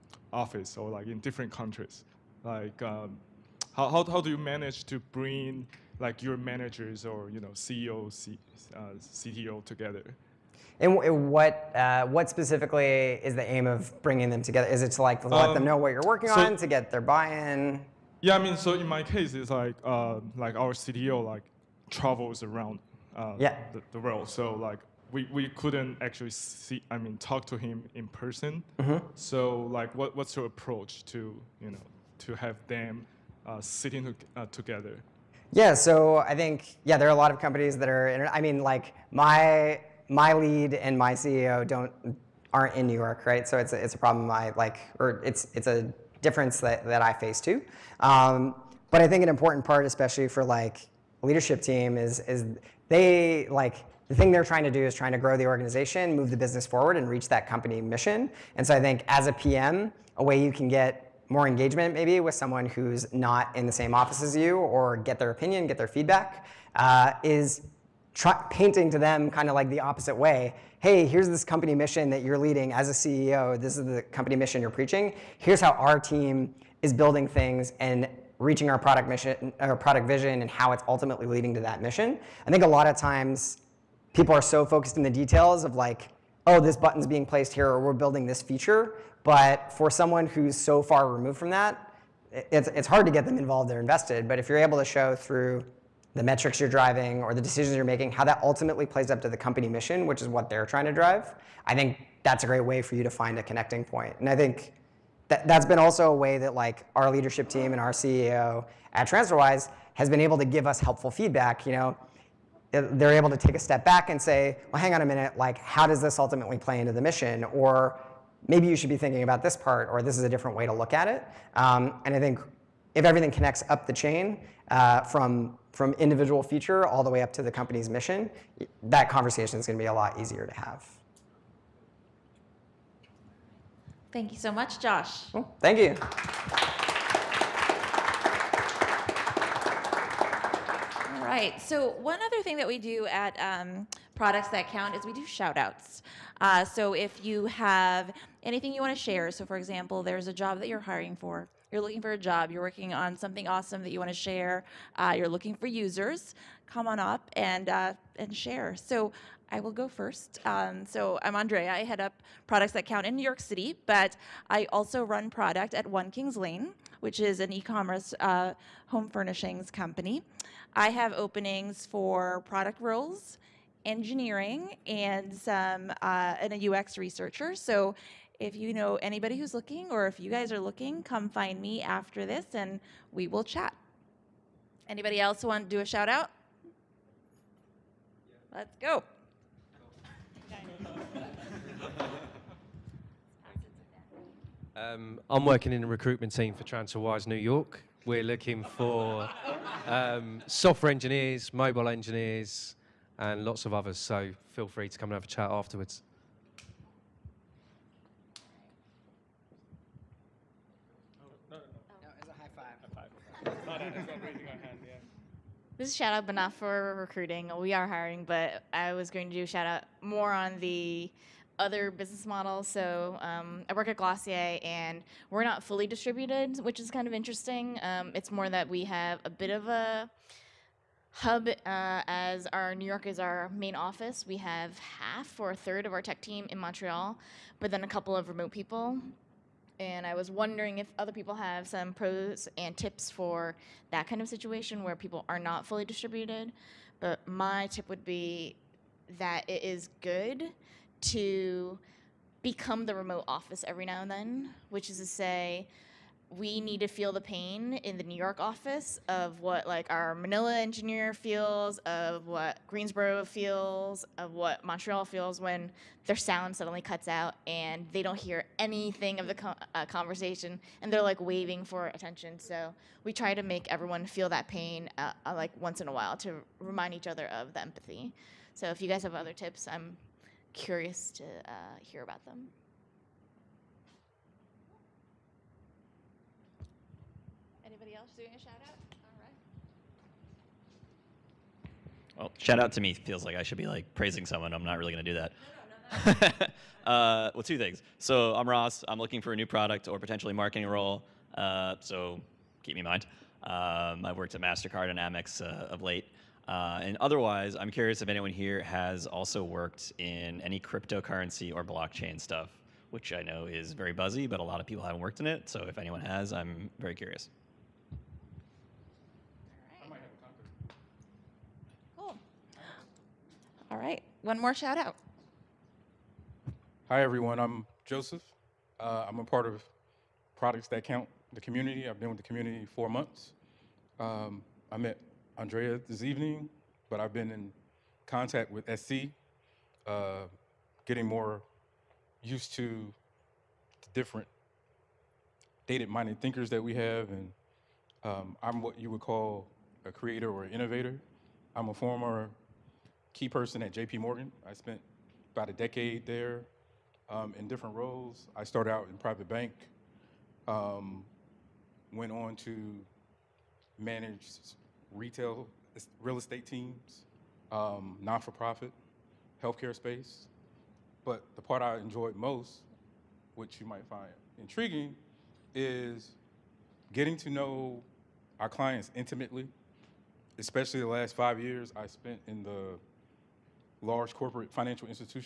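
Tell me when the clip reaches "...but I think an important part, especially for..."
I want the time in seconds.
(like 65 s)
48 s.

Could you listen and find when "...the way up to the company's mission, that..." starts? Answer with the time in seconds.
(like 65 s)
127 s.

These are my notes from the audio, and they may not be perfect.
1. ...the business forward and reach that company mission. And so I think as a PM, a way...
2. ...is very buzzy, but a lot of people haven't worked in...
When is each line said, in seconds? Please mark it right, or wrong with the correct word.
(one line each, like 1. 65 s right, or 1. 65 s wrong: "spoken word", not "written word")
1. 56 s right
2. 313 s right.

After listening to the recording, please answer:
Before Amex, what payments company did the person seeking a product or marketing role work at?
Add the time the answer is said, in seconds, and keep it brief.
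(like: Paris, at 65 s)
Mastercard, at 304 s.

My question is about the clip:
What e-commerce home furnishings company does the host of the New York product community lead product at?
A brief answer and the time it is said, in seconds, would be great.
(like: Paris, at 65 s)
One Kings Lane, at 165 s.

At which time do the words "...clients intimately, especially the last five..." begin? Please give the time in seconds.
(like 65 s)
378 s.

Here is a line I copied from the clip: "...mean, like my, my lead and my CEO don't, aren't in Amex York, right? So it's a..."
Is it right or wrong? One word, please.
wrong.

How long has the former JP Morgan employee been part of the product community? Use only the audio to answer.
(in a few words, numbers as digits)
4 months.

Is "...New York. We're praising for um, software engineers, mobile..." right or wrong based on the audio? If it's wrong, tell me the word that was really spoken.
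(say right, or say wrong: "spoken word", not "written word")
wrong: "looking", not "praising".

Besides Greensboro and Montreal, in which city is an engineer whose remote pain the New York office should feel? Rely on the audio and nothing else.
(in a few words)
Manila.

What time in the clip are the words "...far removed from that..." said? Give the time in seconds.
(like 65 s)
90 s.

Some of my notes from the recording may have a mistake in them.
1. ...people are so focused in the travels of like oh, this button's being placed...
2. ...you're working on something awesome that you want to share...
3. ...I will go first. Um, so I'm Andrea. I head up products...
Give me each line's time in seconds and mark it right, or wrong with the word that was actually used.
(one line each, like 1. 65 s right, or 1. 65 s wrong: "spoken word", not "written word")
1. 84 s wrong: "details", not "travels"
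2. 152 s right
3. 159 s right.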